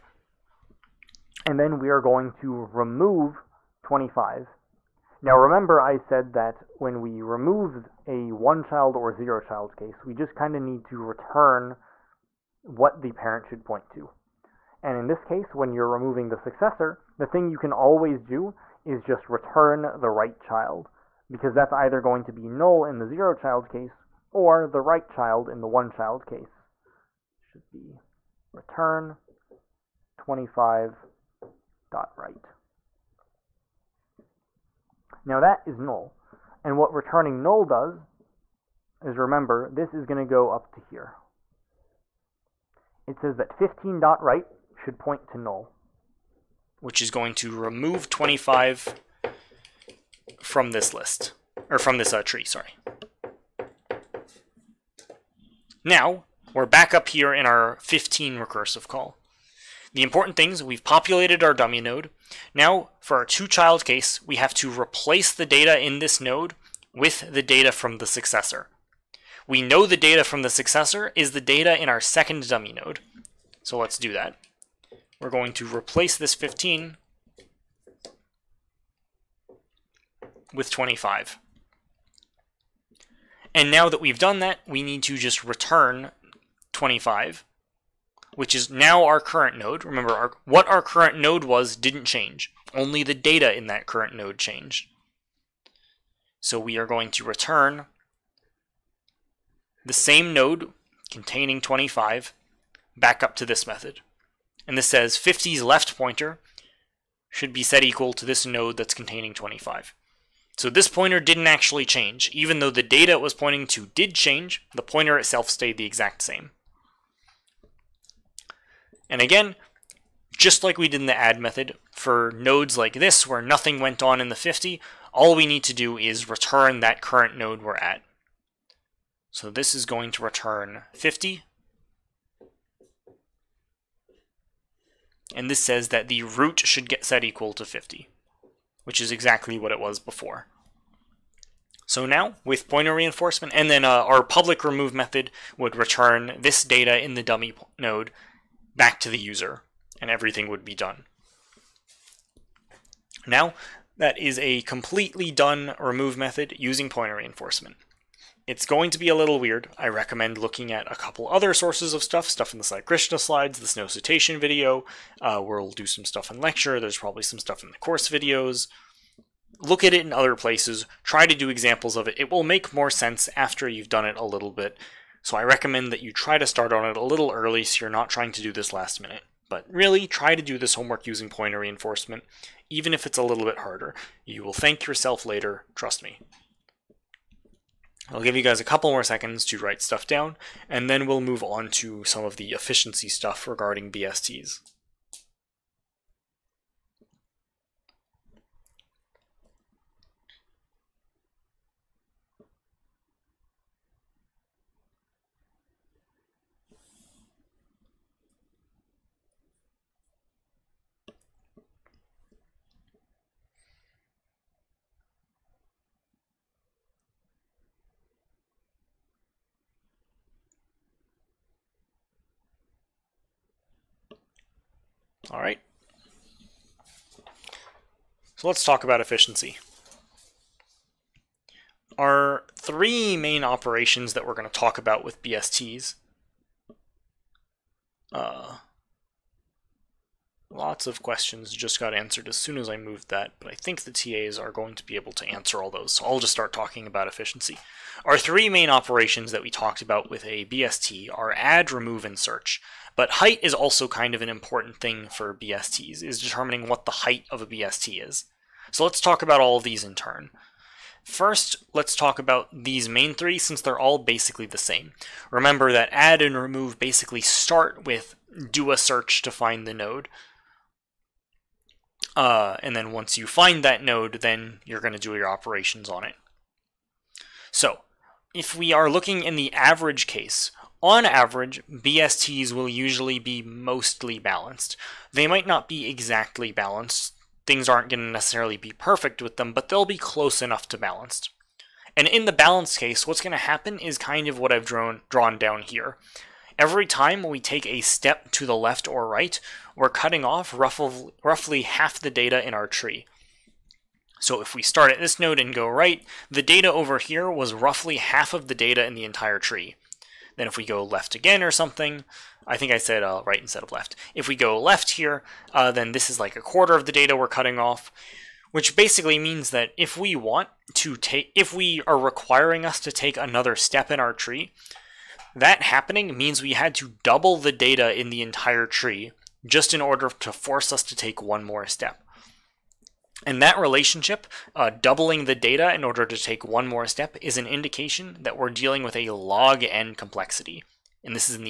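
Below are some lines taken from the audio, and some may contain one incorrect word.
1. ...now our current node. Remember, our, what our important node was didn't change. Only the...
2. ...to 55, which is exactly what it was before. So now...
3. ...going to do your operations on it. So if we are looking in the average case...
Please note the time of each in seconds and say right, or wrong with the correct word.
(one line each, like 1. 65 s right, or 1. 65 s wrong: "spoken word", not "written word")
1. 88 s wrong: "current", not "important"
2. 137 s wrong: "50", not "55"
3. 274 s right.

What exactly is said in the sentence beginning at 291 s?
And in the balanced case, what's going to happen is kind of what I've drawn, drawn down here.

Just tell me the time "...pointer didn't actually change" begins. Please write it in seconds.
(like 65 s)
110 s.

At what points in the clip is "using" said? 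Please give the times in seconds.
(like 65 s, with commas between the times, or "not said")
156 s, 181 s.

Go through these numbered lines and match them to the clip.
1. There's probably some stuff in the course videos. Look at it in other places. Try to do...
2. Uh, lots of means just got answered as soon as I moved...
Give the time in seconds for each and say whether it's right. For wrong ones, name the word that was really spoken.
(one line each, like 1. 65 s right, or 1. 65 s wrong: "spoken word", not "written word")
1. 166 s right
2. 238 s wrong: "questions", not "means".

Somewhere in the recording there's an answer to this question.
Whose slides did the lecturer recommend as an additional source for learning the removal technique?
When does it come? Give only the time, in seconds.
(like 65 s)
162 s.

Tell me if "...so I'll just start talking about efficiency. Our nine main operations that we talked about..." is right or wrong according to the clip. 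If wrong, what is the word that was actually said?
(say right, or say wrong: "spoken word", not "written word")
wrong: "three", not "nine".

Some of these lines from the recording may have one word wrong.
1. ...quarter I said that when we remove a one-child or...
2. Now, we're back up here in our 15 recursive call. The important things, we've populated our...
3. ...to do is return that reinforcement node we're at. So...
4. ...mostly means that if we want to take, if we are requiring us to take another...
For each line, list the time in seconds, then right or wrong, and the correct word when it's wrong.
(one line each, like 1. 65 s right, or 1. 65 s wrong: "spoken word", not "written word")
1. 5 s wrong: "remember", not "quarter"
2. 55 s right
3. 125 s wrong: "current", not "reinforcement"
4. 318 s wrong: "basically", not "mostly".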